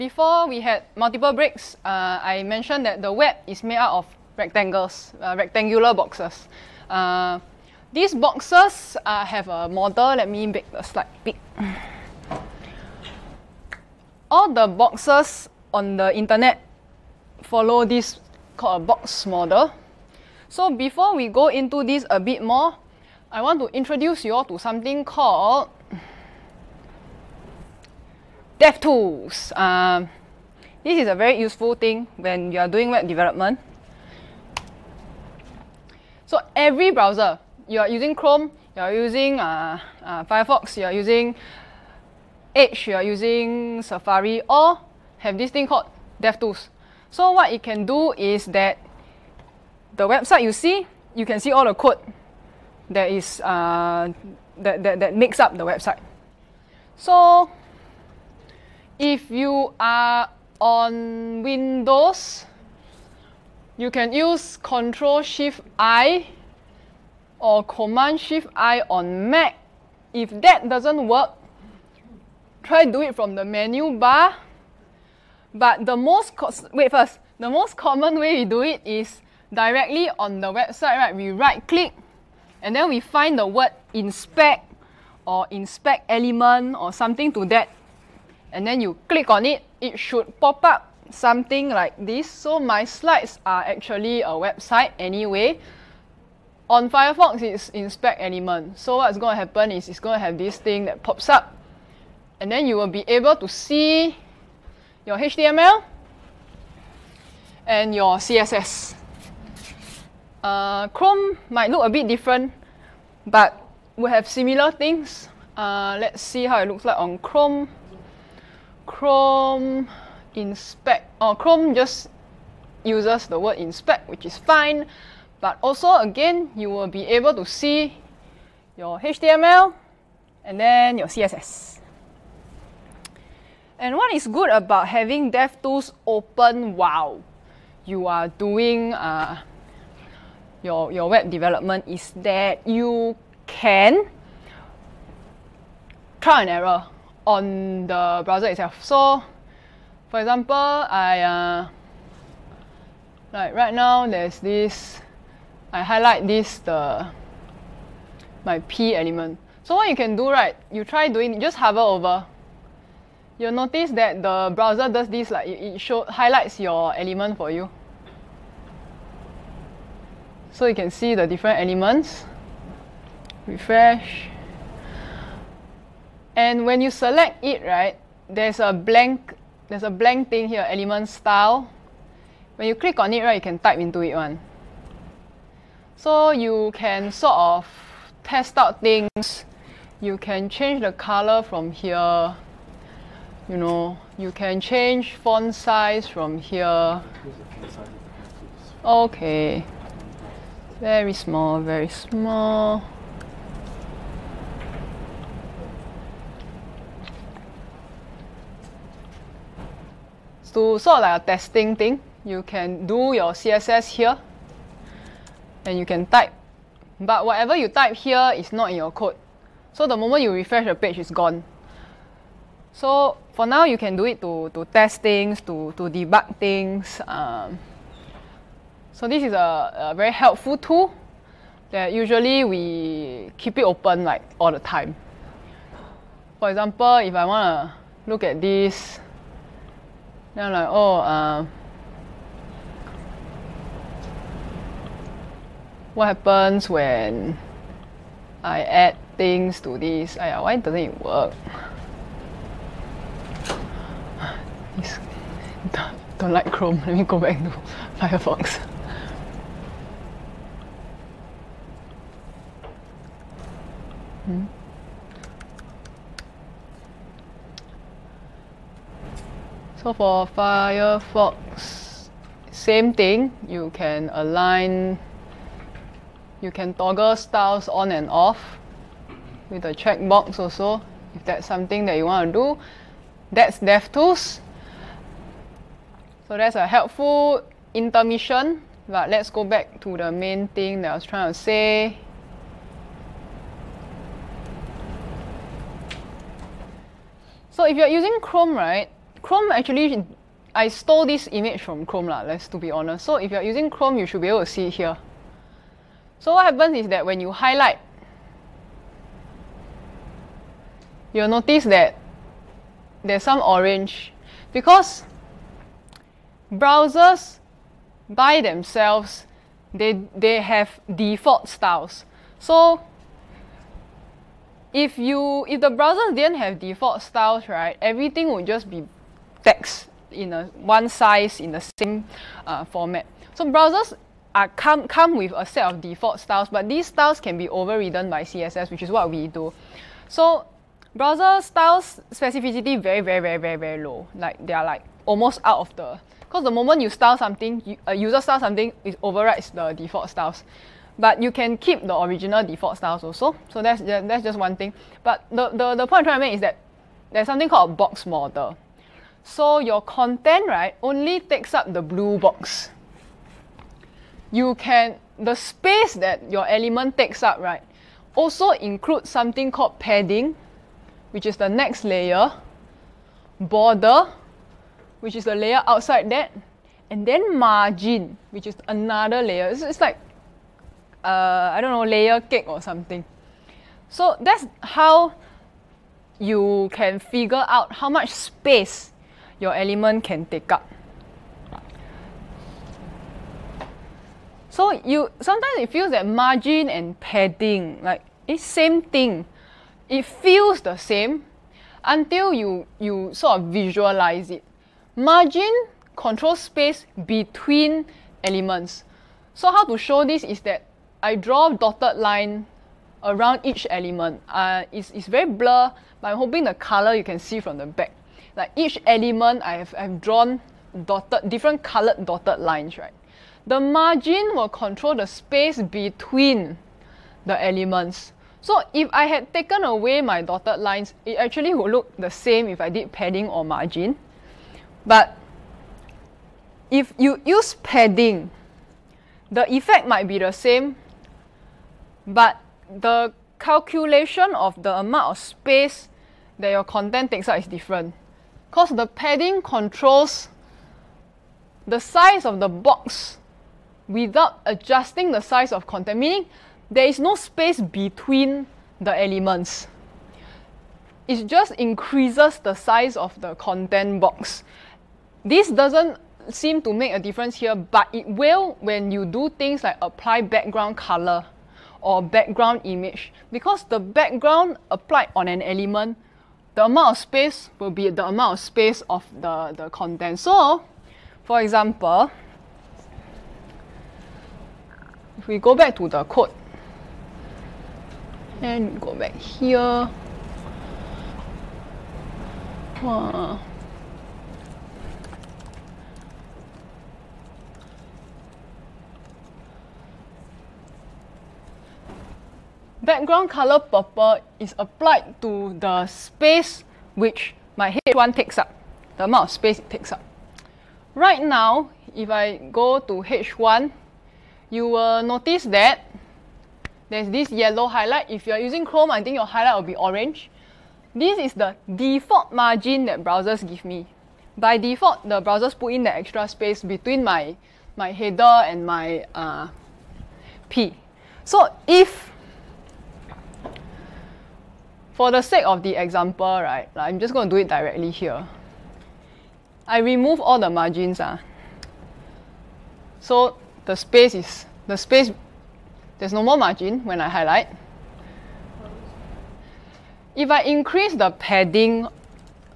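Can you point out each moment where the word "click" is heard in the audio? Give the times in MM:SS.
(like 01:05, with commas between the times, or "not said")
01:21, 01:29, 03:02.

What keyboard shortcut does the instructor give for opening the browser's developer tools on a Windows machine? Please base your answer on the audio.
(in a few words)
Control Shift I.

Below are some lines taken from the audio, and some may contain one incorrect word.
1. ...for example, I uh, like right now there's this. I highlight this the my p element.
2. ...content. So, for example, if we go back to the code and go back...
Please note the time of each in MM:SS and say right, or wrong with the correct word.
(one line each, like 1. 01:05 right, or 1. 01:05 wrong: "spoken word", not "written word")
1. 02:30 right
2. 07:59 right.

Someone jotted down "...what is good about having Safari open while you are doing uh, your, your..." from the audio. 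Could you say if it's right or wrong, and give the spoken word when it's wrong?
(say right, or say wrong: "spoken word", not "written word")
wrong: "DevTools", not "Safari".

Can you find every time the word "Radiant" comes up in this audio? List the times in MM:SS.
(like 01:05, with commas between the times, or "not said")
not said.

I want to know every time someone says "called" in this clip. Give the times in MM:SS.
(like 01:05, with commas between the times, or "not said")
00:18, 00:25, 00:45, 05:57, 06:09.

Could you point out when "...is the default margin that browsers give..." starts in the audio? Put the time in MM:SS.
08:41.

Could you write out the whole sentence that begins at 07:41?
It just increases the size of the content box.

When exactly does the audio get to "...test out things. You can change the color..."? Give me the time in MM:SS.
03:08.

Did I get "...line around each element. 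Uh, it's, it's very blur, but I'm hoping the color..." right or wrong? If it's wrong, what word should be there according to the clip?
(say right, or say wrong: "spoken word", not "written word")
right.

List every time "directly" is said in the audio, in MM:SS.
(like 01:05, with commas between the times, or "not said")
01:19, 08:57.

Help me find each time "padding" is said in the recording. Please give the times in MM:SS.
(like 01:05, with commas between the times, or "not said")
06:09, 06:36, 07:12, 07:17, 07:28, 09:11.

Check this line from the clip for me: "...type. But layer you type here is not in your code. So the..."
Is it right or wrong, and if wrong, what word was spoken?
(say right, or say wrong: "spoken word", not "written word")
wrong: "whatever", not "layer".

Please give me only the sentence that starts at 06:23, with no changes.
So that's how you can figure out how much space your element can take up.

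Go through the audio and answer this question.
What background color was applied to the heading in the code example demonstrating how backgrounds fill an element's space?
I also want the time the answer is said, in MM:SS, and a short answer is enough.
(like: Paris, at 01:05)
Purple, at 08:22.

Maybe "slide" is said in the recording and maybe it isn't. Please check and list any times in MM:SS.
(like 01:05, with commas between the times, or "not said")
00:10, 01:32.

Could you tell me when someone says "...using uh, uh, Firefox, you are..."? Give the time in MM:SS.
00:38.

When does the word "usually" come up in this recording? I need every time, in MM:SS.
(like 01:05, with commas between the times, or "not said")
03:51.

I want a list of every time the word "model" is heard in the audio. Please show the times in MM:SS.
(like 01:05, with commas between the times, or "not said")
00:09, 00:19, 05:58.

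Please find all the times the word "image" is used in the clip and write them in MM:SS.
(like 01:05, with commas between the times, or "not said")
05:01, 07:52.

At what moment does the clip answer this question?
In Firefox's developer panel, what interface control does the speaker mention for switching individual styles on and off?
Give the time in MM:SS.
04:39.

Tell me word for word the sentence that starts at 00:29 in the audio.
Um, this is a very useful thing when you are doing web development.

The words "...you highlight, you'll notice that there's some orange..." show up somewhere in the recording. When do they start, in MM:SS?
05:07.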